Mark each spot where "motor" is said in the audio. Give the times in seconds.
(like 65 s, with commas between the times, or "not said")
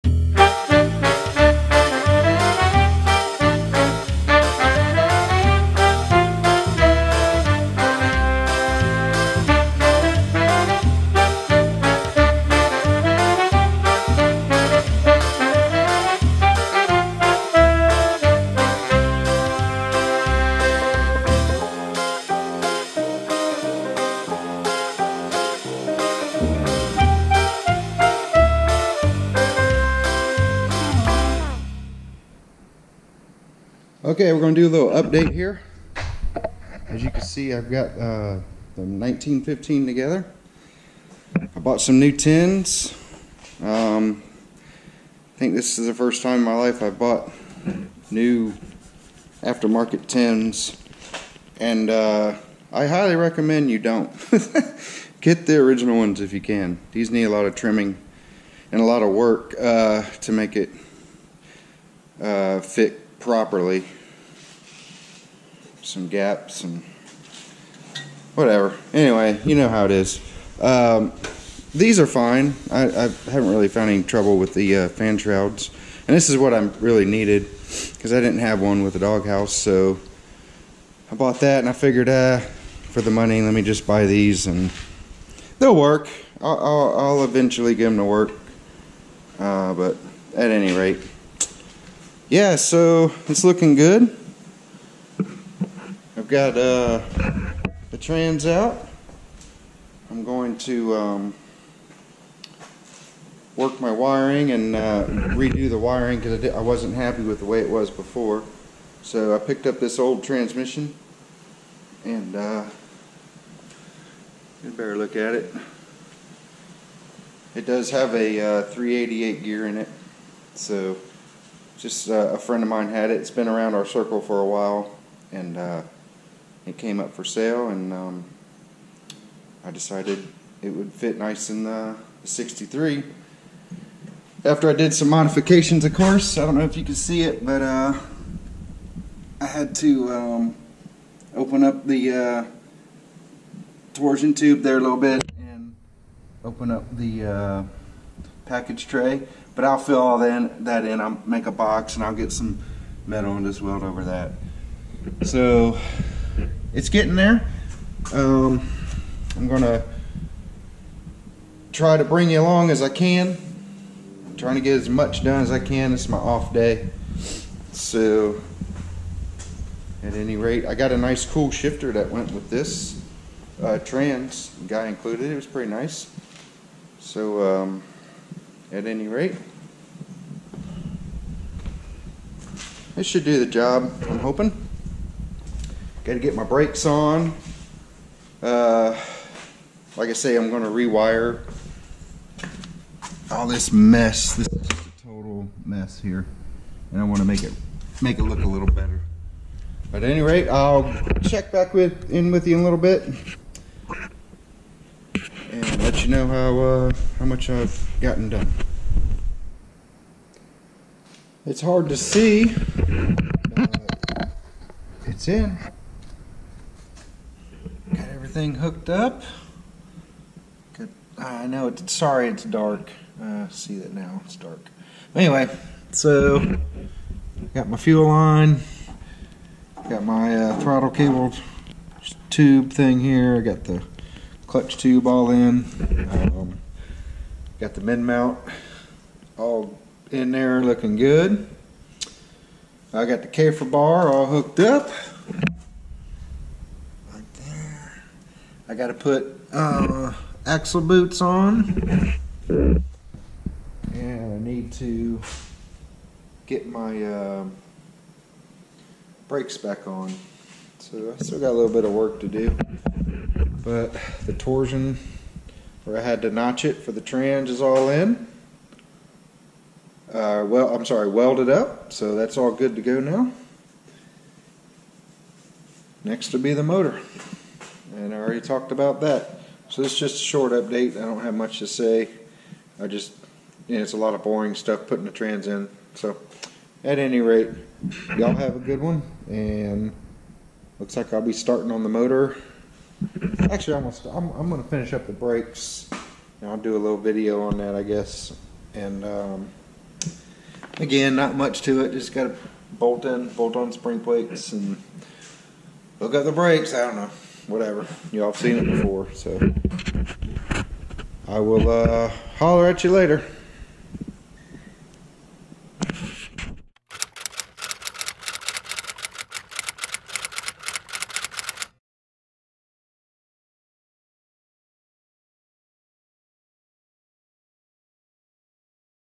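276 s, 291 s.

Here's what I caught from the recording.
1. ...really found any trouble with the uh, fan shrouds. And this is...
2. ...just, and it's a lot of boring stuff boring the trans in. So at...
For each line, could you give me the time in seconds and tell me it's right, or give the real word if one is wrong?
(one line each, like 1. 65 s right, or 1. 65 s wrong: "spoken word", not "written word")
1. 73 s right
2. 282 s wrong: "putting", not "boring".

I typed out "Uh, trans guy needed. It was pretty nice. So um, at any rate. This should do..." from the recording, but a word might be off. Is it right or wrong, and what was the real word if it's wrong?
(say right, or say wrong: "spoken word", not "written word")
wrong: "included", not "needed".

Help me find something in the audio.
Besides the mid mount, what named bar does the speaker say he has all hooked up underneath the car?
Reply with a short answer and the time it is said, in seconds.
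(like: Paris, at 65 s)
Kafer bar, at 243 s.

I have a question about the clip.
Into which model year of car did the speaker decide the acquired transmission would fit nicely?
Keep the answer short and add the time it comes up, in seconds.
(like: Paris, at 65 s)
63, at 132 s.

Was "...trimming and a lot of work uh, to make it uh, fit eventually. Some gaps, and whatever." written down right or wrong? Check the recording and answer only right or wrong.
wrong.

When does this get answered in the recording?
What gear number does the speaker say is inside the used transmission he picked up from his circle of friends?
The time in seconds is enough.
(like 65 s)
118 s.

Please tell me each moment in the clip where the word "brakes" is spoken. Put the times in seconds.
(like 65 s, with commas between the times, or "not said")
186 s, 259 s, 295 s, 306 s.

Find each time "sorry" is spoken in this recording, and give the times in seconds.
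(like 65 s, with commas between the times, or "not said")
221 s, 270 s.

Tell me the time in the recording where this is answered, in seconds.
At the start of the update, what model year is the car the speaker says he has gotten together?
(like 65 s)
38 s.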